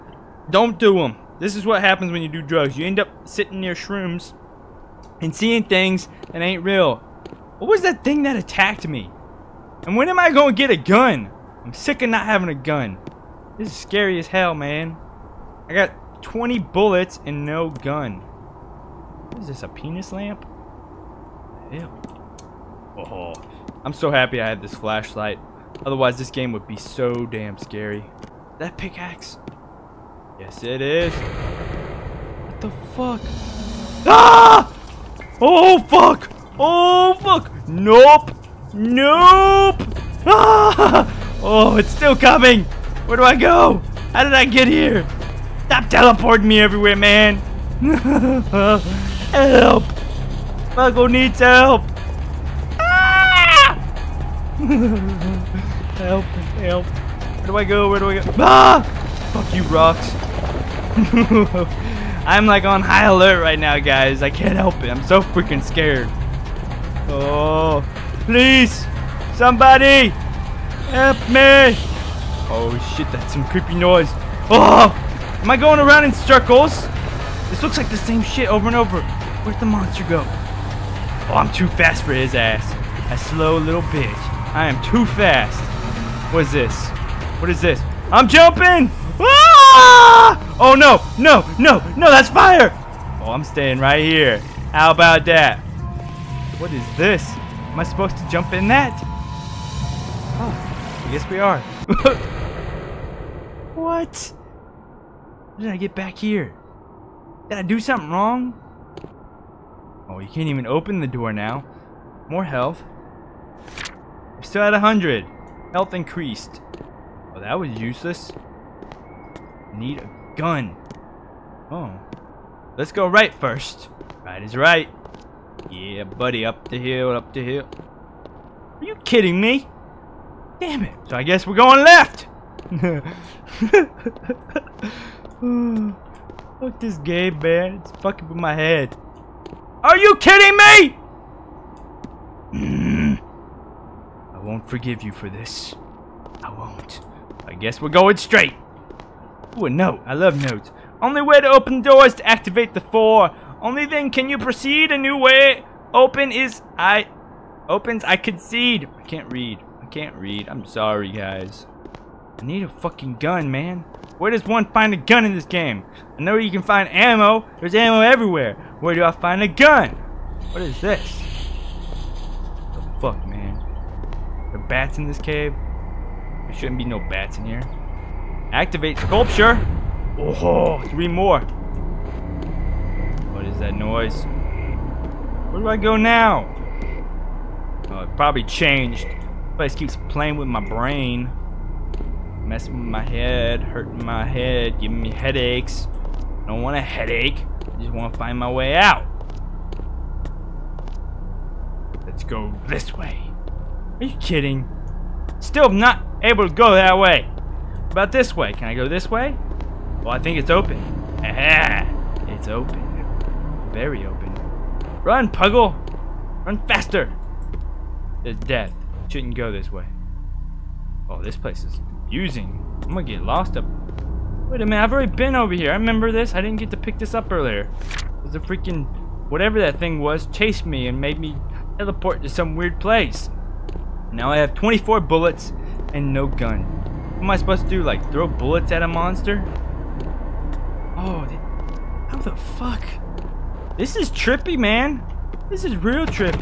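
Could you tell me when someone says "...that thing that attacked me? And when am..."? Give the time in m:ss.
0:07.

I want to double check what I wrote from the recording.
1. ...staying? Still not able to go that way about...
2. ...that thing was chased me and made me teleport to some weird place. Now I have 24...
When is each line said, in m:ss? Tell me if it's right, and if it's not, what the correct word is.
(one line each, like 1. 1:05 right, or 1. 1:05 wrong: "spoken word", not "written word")
1. 3:24 wrong: "kidding", not "staying"
2. 3:49 right.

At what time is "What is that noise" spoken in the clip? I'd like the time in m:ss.
3:03.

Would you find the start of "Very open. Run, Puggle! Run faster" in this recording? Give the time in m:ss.
3:33.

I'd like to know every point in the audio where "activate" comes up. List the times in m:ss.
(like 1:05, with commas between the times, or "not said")
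2:32, 2:58.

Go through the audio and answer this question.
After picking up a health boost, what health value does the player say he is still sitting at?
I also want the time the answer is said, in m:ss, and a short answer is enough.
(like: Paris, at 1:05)
100, at 1:54.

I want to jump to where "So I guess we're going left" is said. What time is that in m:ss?
2:11.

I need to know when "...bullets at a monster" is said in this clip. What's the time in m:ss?
3:58.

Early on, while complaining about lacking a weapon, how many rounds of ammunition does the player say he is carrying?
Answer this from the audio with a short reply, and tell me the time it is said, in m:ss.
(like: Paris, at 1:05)
20, at 0:16.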